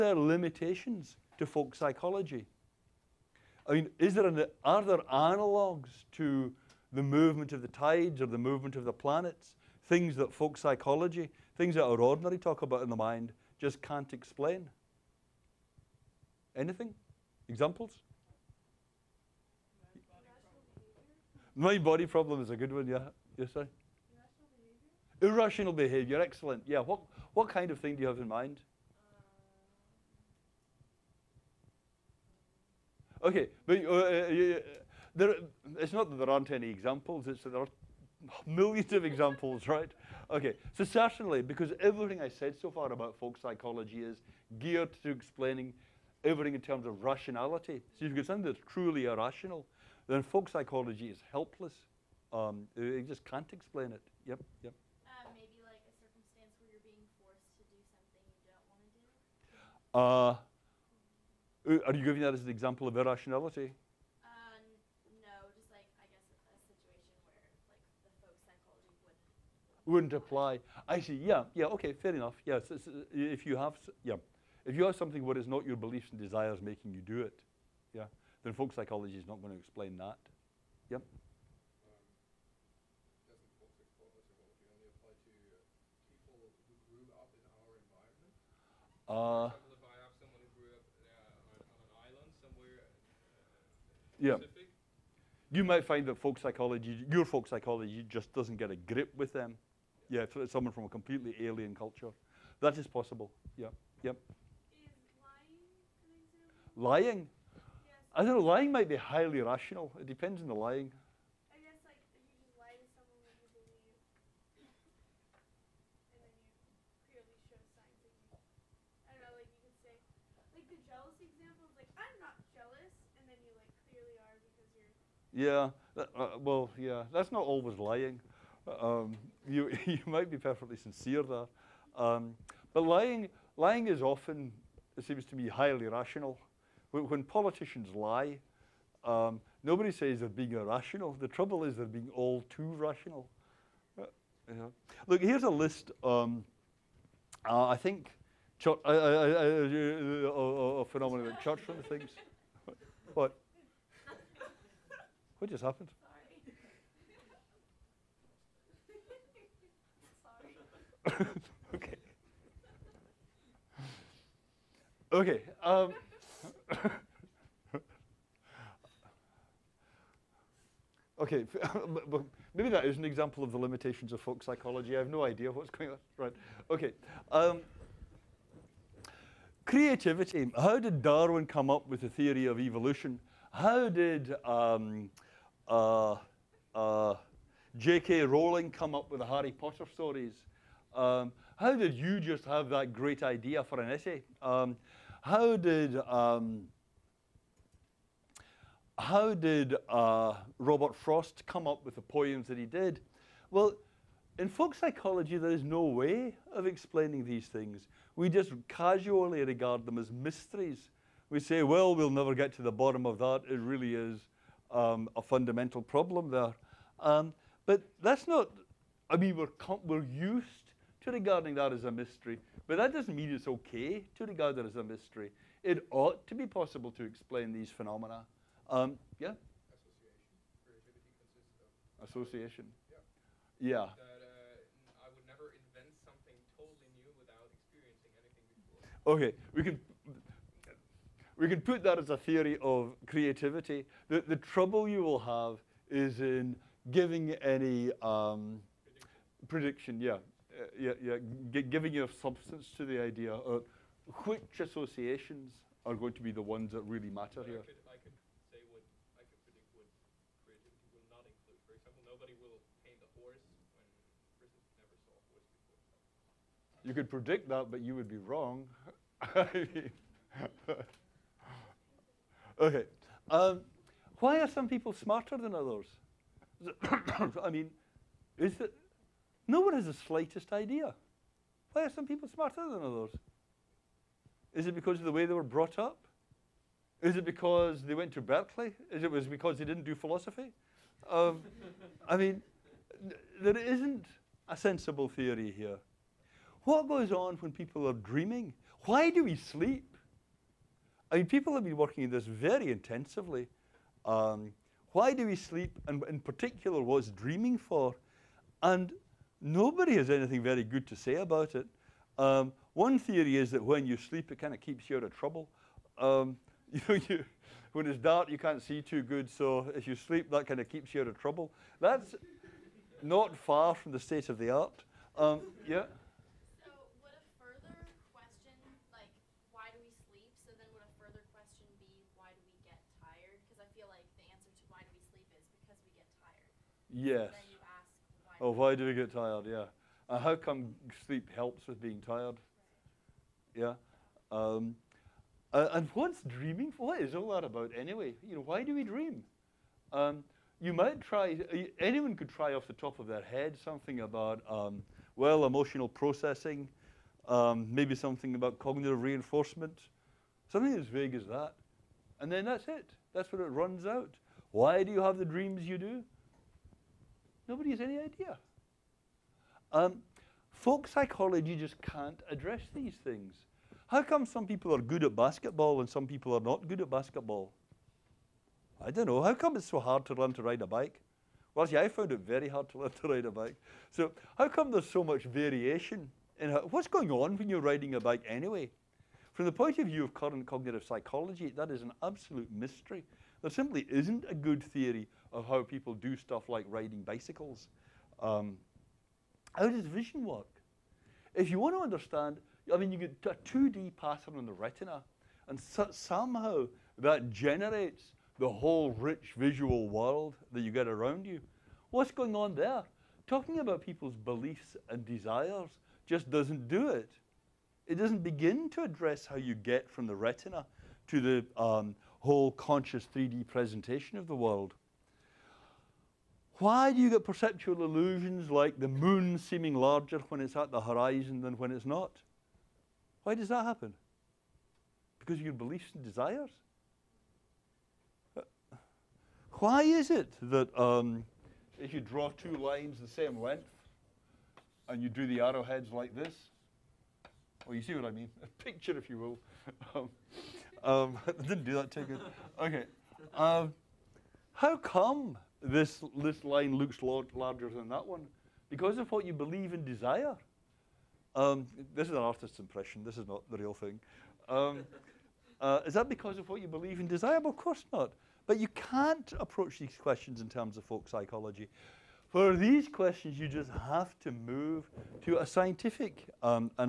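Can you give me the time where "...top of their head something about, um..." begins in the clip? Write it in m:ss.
5:52.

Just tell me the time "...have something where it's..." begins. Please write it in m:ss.
1:14.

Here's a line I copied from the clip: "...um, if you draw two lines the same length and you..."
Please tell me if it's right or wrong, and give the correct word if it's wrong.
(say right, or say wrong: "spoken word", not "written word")
right.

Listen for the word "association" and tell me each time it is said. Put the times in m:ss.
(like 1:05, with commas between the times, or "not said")
3:52, 4:14.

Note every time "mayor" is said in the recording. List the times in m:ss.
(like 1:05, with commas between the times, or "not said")
not said.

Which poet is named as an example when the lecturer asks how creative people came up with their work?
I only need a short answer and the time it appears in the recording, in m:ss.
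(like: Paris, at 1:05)
Robert Frost, at 3:20.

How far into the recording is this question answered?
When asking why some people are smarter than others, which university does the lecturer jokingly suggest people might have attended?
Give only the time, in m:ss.
4:48.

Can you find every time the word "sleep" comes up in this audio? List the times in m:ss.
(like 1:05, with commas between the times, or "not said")
4:59, 5:05, 5:13, 5:19, 5:41.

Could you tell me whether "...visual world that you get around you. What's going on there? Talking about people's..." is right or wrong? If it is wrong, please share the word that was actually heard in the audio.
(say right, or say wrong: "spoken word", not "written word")
right.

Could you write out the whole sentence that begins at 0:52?
Um, it, it just can't explain it.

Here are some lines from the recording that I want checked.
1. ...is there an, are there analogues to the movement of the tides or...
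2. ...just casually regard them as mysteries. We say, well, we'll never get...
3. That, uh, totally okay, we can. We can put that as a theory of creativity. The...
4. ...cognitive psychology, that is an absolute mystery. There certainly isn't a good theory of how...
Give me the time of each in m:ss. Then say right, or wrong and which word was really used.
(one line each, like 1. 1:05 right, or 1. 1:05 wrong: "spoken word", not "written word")
1. 0:03 right
2. 3:28 right
3. 3:53 right
4. 6:30 wrong: "simply", not "certainly".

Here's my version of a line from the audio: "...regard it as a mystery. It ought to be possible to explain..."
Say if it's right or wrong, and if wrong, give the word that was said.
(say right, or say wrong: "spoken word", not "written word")
right.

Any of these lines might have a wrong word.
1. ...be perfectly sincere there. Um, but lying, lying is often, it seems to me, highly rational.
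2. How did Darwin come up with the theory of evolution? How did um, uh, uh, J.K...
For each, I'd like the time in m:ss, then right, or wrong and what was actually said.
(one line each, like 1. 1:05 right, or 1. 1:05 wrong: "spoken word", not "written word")
1. 2:10 right
2. 3:00 right.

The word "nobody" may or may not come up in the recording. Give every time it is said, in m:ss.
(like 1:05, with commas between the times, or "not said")
2:19, 5:09, 6:07.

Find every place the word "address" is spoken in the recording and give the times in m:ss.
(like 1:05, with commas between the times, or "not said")
6:12, 6:58.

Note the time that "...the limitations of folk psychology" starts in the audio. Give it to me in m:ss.
2:53.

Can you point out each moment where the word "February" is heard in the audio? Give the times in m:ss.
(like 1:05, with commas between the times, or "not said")
not said.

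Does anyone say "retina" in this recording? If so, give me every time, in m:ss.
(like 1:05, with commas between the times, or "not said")
6:44, 7:00.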